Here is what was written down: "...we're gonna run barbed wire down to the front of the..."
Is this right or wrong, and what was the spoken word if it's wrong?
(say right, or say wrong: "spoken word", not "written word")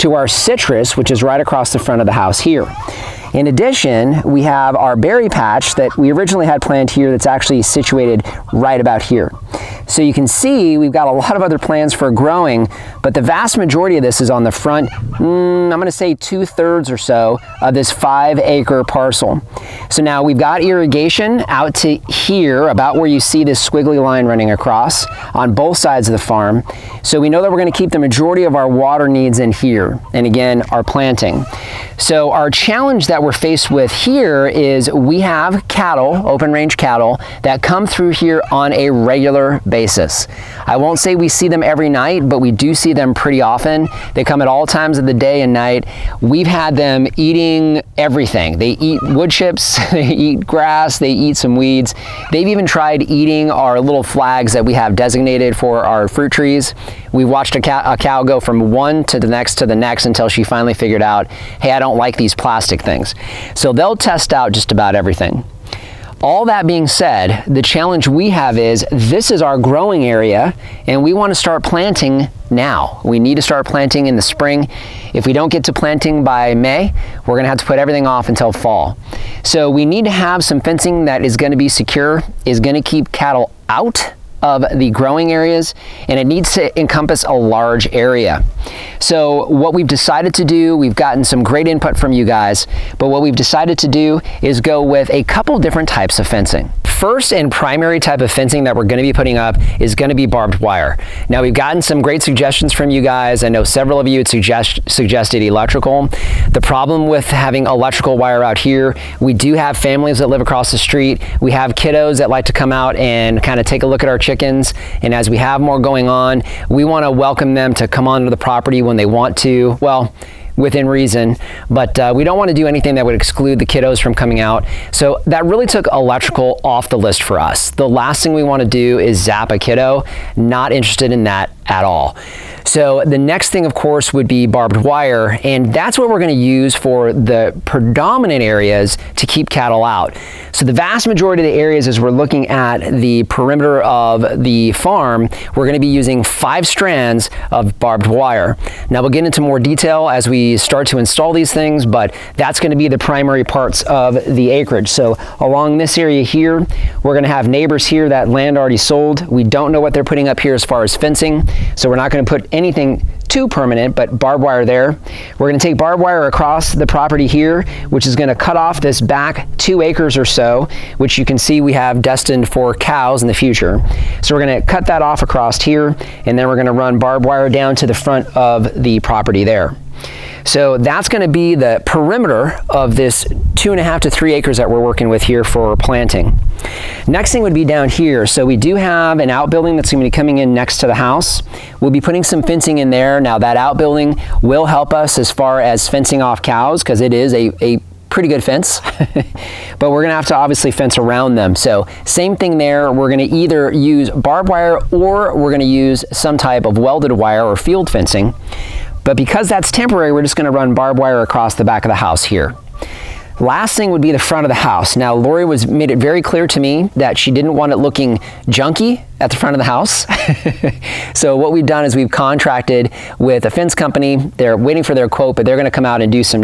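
right.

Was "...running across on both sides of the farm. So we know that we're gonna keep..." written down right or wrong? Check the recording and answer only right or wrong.
right.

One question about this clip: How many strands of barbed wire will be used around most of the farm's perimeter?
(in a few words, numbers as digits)
5.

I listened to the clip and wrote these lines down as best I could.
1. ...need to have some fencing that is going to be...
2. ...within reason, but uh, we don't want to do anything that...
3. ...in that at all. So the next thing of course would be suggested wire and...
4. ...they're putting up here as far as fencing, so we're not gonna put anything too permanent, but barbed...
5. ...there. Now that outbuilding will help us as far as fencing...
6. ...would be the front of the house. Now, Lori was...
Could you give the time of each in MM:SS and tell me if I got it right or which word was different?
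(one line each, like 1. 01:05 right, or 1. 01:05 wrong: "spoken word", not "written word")
1. 01:19 right
2. 02:00 right
3. 02:11 wrong: "barbed", not "suggested"
4. 02:39 right
5. 03:12 right
6. 03:33 right.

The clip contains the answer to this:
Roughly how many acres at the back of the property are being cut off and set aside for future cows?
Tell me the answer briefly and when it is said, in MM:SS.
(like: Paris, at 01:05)
2, at 02:49.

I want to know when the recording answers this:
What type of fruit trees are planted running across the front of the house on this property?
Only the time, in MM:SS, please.
00:00.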